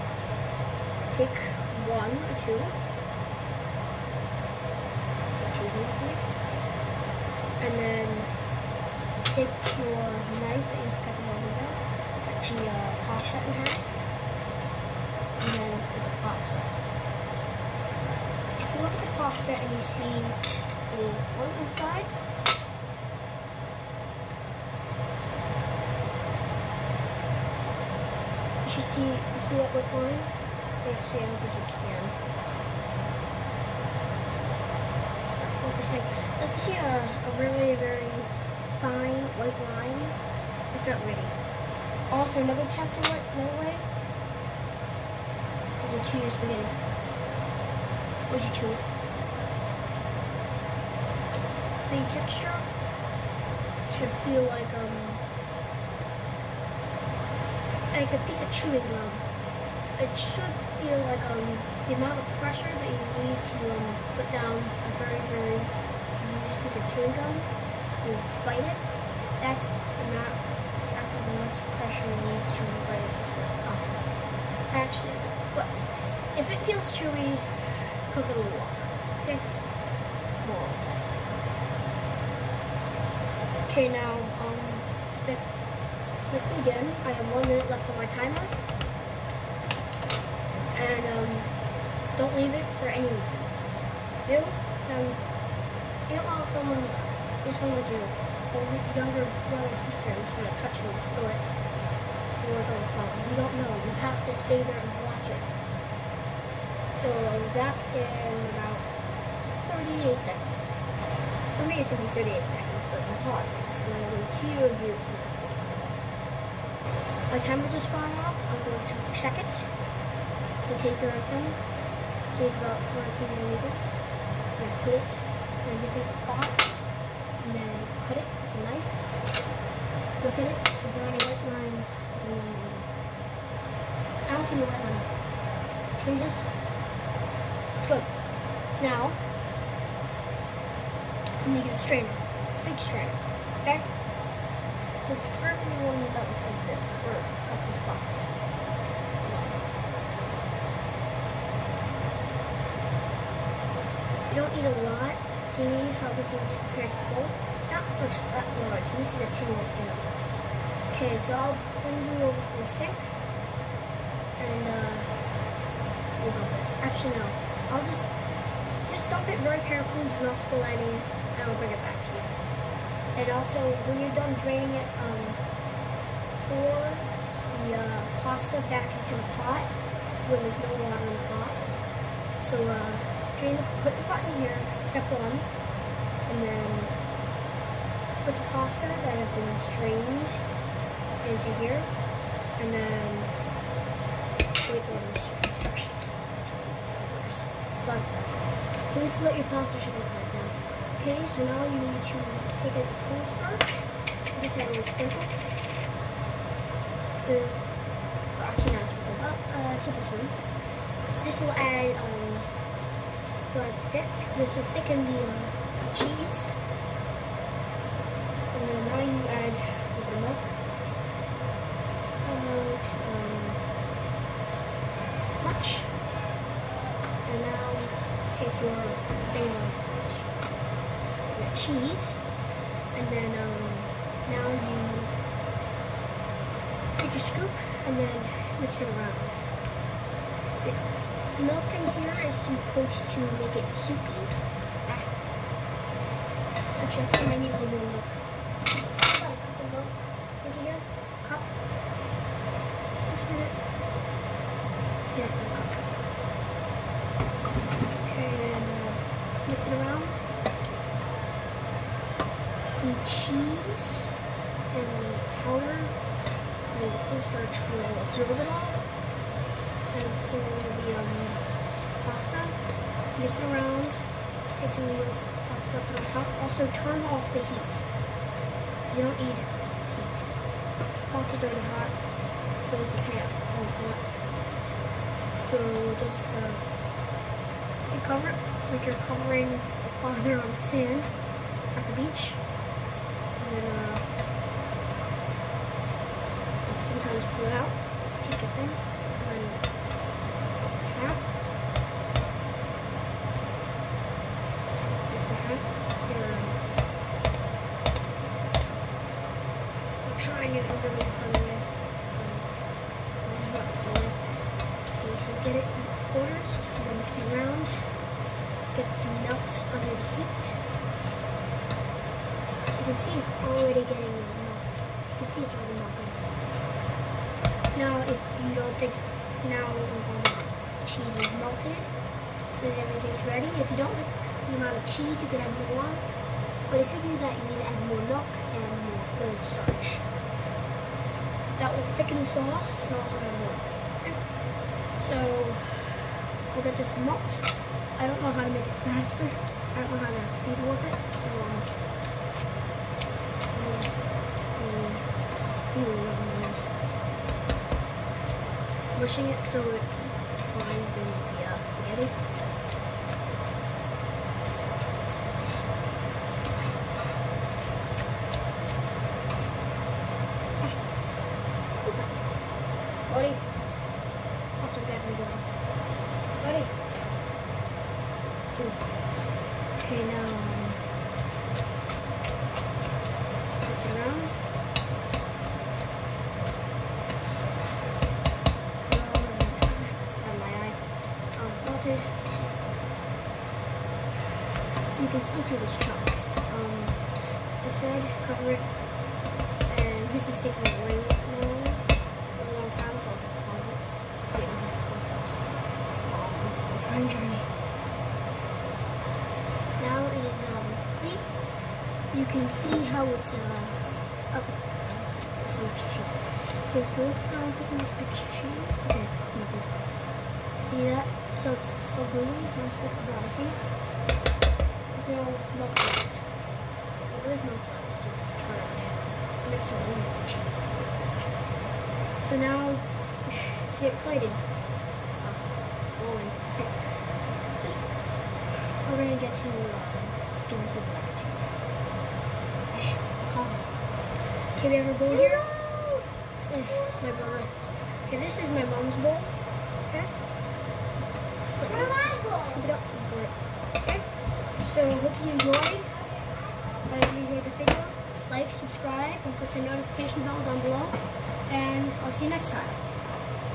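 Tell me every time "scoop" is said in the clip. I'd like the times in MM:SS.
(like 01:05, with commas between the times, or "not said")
03:57, 07:32.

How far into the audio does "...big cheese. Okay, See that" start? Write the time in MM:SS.
06:57.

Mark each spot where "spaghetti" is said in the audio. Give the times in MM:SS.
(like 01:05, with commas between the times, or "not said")
00:46, 06:01.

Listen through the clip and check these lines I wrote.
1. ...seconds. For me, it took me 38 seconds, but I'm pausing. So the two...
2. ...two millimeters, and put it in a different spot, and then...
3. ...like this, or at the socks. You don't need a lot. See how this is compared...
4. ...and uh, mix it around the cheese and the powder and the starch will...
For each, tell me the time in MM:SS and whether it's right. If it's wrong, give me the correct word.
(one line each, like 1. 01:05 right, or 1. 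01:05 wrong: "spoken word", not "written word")
1. 01:50 right
2. 02:03 right
3. 02:26 right
4. 04:18 wrong: "cornstarch", not "starch".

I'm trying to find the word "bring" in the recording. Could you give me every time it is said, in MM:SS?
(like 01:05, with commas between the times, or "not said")
02:41, 02:51.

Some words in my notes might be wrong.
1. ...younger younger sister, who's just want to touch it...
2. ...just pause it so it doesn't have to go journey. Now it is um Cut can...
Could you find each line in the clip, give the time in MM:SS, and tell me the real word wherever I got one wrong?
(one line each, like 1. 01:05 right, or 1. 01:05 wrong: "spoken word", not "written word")
1. 01:38 wrong: "brother", not "younger"
2. 06:43 wrong: "You", not "Cut".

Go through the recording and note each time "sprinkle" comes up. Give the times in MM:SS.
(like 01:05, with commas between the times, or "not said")
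03:24, 03:28.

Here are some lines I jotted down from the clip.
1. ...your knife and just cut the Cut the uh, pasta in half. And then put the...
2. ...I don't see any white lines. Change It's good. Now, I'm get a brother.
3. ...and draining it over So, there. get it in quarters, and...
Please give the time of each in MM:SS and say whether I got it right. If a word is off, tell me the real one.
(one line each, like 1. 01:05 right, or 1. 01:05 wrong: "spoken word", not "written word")
1. 00:09 right
2. 02:12 wrong: "strainer", not "brother"
3. 05:10 wrong: "trying", not "draining".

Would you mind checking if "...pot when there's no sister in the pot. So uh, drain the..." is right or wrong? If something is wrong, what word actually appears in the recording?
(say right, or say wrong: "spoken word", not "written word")
wrong: "water", not "sister".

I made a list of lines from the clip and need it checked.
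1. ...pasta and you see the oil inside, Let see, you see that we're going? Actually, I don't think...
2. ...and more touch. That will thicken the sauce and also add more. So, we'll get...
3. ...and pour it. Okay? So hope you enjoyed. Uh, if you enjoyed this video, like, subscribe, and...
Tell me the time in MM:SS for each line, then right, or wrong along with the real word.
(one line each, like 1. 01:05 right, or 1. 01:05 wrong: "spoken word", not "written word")
1. 00:19 wrong: "You", not "Let"
2. 05:38 wrong: "cornstarch", not "touch"
3. 07:32 right.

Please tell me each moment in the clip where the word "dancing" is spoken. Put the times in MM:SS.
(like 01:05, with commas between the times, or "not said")
not said.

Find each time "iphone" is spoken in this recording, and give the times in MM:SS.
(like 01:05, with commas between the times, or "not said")
02:01.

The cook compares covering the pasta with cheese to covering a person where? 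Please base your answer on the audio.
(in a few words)
the beach.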